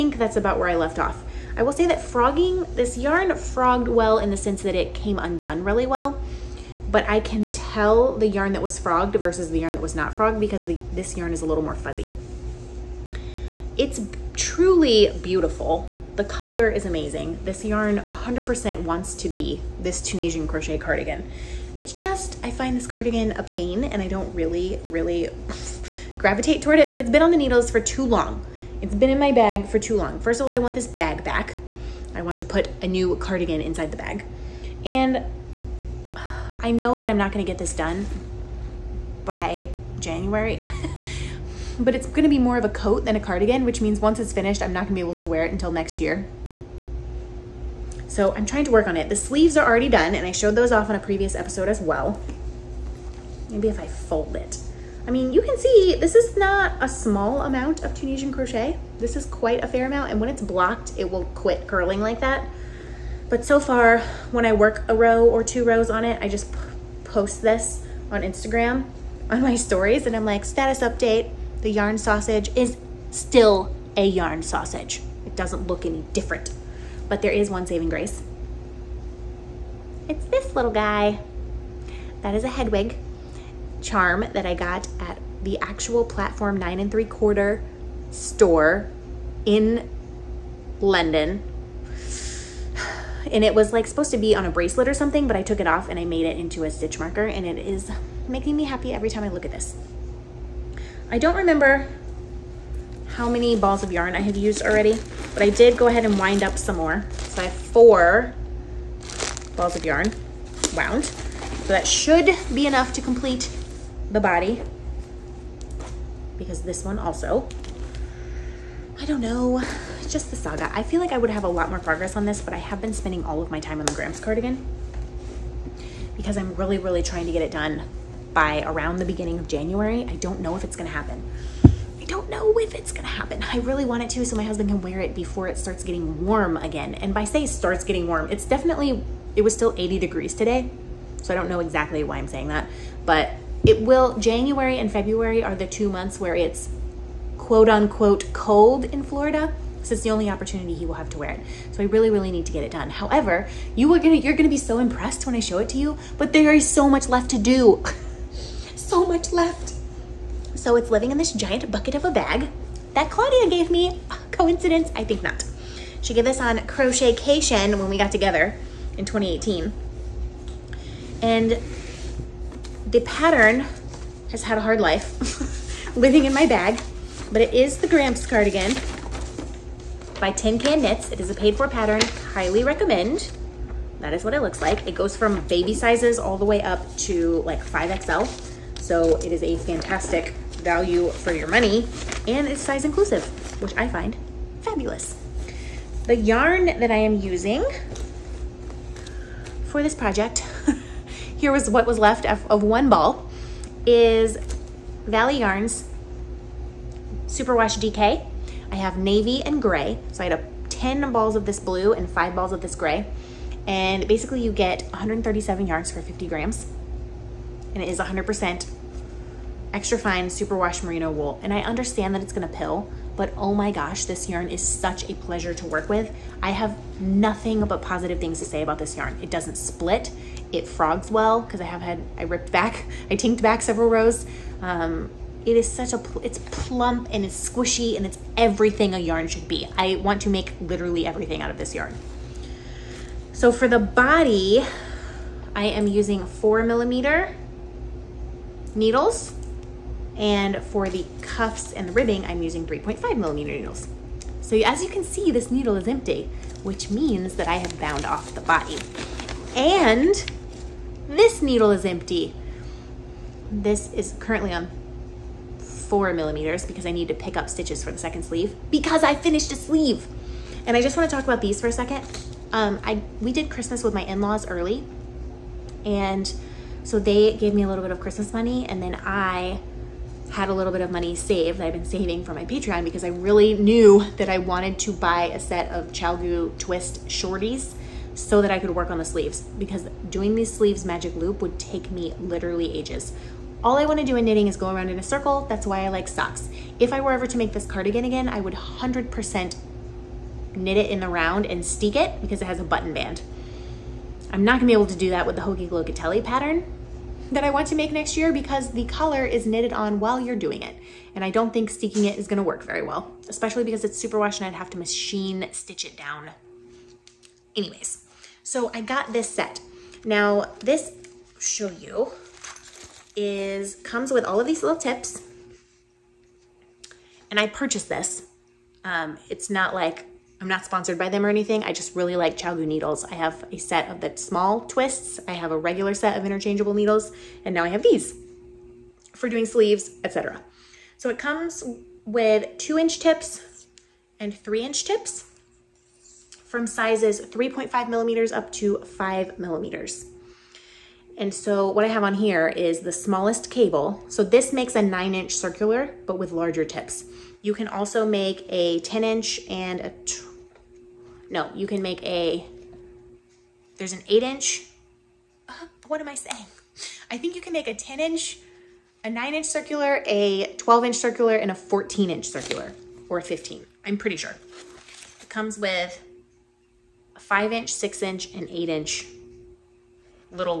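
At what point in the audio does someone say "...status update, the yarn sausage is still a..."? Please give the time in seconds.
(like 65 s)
70 s.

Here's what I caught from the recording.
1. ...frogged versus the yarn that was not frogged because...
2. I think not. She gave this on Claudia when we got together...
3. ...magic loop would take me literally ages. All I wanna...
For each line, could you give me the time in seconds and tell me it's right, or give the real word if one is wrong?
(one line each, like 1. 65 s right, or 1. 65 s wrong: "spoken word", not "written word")
1. 8 s right
2. 164 s wrong: "Crochetcation", not "Claudia"
3. 290 s right.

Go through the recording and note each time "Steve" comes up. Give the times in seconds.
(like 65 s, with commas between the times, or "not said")
not said.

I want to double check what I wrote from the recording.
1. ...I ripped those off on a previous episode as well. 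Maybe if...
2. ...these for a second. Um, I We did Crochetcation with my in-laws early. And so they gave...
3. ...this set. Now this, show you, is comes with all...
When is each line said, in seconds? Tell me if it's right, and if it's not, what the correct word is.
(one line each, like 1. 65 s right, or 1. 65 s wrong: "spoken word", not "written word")
1. 50 s wrong: "showed", not "ripped"
2. 271 s wrong: "Christmas", not "Crochetcation"
3. 319 s right.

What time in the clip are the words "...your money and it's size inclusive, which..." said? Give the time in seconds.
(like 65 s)
191 s.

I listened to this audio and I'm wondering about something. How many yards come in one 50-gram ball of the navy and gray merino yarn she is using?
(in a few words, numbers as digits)
137.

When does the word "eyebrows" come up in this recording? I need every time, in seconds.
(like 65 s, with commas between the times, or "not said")
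not said.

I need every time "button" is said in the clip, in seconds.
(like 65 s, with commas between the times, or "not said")
302 s.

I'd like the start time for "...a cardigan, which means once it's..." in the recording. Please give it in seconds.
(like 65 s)
43 s.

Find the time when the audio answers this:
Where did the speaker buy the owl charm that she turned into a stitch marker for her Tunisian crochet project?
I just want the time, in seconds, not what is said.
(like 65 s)
90 s.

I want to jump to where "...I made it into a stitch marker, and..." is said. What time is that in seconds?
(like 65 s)
95 s.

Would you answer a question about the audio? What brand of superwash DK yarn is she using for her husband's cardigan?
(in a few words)
Valley Yarns.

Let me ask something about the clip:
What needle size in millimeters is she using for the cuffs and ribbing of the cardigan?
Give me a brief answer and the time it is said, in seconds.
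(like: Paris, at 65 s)
3.5 millimeters, at 252 s.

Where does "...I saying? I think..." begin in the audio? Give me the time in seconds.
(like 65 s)
366 s.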